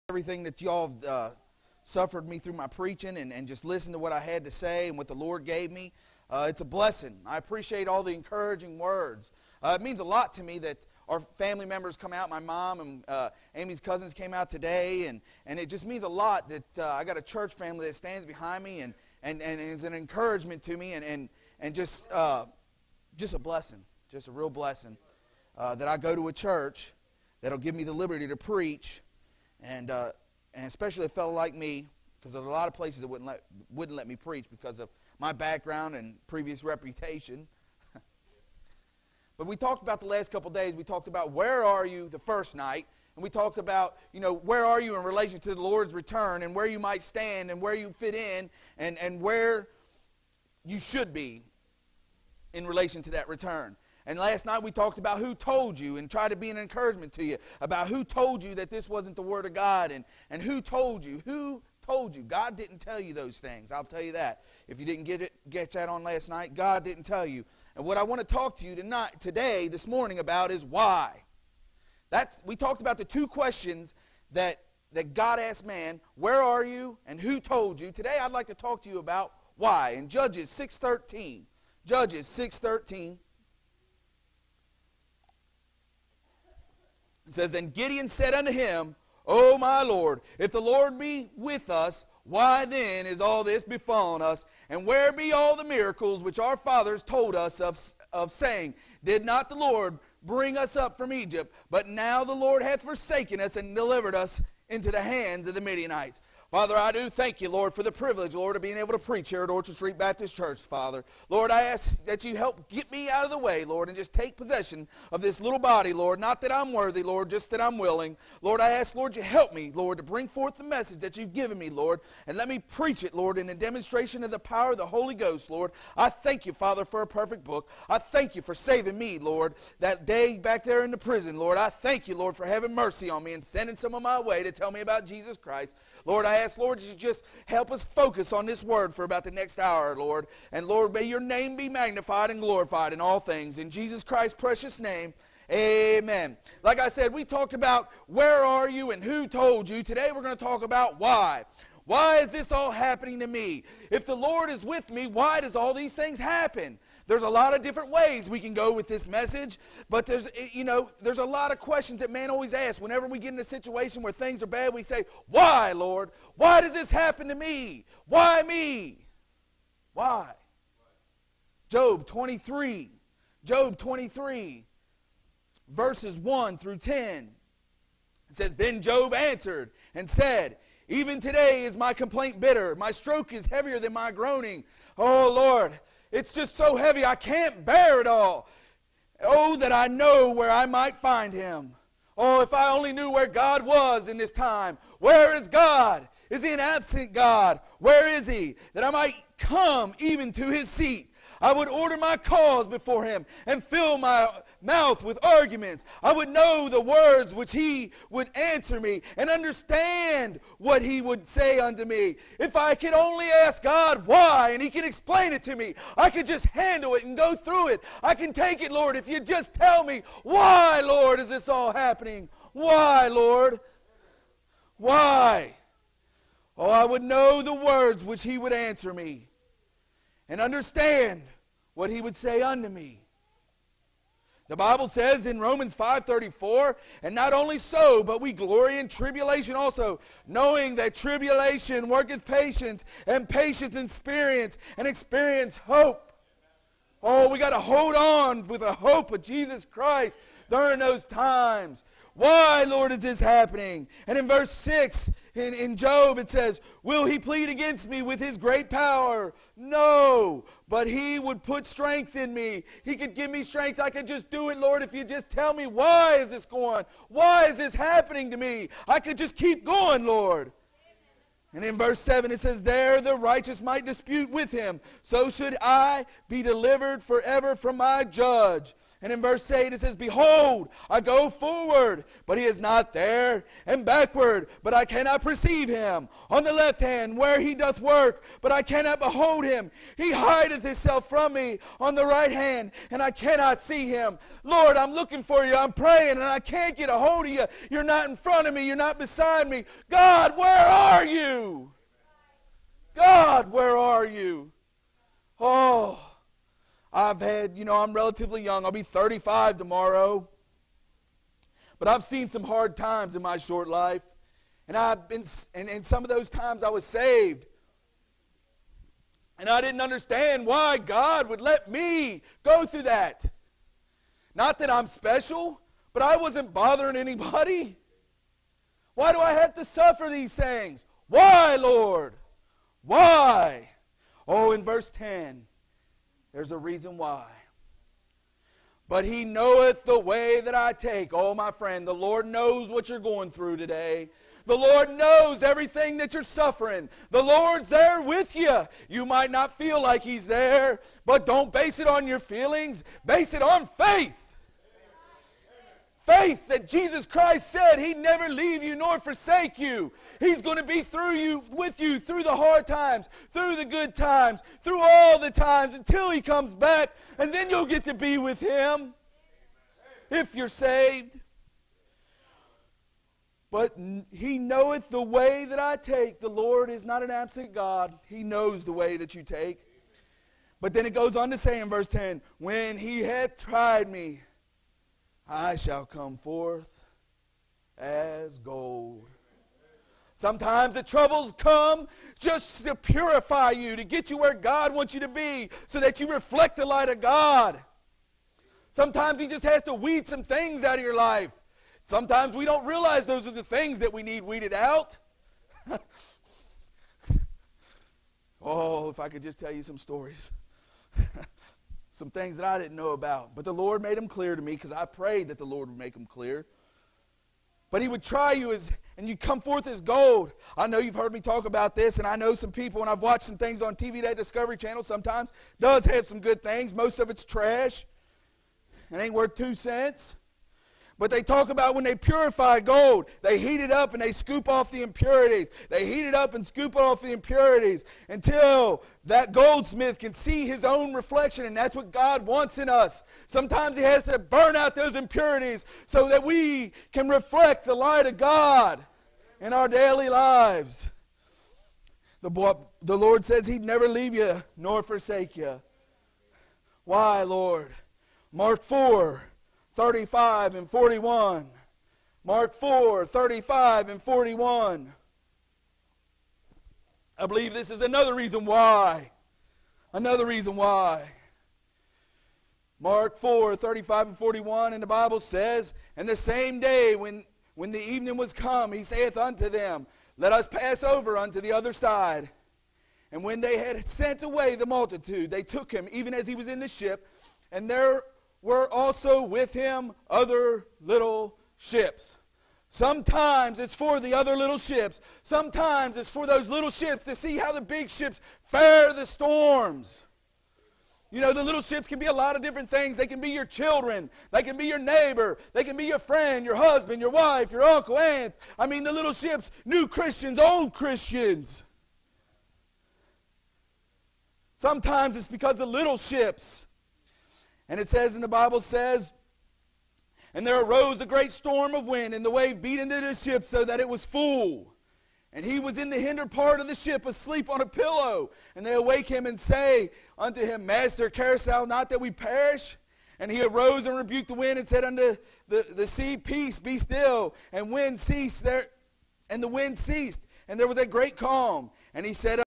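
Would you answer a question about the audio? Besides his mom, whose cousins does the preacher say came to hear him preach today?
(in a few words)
Amy's.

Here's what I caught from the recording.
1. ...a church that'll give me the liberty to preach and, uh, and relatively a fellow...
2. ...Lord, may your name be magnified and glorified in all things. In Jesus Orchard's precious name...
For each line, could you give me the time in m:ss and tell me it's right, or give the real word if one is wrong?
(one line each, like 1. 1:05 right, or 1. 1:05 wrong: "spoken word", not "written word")
1. 0:26 wrong: "especially", not "relatively"
2. 2:20 wrong: "Christ", not "Orchard".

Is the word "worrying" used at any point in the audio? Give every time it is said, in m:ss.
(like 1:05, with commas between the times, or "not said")
not said.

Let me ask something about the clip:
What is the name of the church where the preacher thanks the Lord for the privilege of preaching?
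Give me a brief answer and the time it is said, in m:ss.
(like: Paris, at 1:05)
Orchard Street Baptist Church, at 1:49.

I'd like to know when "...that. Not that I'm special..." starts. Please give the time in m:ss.
5:22.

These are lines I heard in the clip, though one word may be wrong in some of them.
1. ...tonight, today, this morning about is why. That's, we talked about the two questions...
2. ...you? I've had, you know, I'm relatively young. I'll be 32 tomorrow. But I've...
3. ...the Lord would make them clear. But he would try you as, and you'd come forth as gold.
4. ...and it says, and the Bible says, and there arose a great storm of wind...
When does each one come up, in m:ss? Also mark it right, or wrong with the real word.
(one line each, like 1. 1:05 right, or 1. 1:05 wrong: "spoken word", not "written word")
1. 1:08 right
2. 5:04 wrong: "35", not "32"
3. 6:55 right
4. 8:37 right.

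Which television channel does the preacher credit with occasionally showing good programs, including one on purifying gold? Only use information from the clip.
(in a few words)
Discovery Channel.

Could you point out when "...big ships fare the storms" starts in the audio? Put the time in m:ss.
8:17.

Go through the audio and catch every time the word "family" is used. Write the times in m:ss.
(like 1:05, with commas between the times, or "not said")
0:11, 0:17.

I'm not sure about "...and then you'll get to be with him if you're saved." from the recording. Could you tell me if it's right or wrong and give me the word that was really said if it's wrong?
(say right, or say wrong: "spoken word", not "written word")
right.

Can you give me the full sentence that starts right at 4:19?
No, but he would put strength in me.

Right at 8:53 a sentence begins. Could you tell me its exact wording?
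And he arose and rebuked the wind and said unto the, the sea, Peace, be still.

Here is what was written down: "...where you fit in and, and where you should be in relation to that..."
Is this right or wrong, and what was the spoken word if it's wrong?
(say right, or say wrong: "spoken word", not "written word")
right.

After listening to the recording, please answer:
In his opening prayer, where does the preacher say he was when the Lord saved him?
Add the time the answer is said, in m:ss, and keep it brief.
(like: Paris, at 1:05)
prison, at 2:10.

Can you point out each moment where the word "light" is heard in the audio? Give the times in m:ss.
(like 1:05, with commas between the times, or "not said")
6:36, 7:27.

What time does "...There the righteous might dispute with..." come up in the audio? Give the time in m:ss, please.
4:32.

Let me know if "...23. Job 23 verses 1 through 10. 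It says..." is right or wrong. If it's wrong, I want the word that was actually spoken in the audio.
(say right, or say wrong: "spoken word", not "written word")
right.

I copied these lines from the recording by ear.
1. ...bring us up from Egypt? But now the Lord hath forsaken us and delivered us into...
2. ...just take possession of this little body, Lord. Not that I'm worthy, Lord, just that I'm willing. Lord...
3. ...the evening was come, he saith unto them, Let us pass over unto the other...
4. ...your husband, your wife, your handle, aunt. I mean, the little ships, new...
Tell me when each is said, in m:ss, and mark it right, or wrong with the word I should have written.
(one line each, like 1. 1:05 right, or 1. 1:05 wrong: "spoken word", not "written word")
1. 1:40 right
2. 1:53 right
3. 7:57 right
4. 8:26 wrong: "uncle", not "handle".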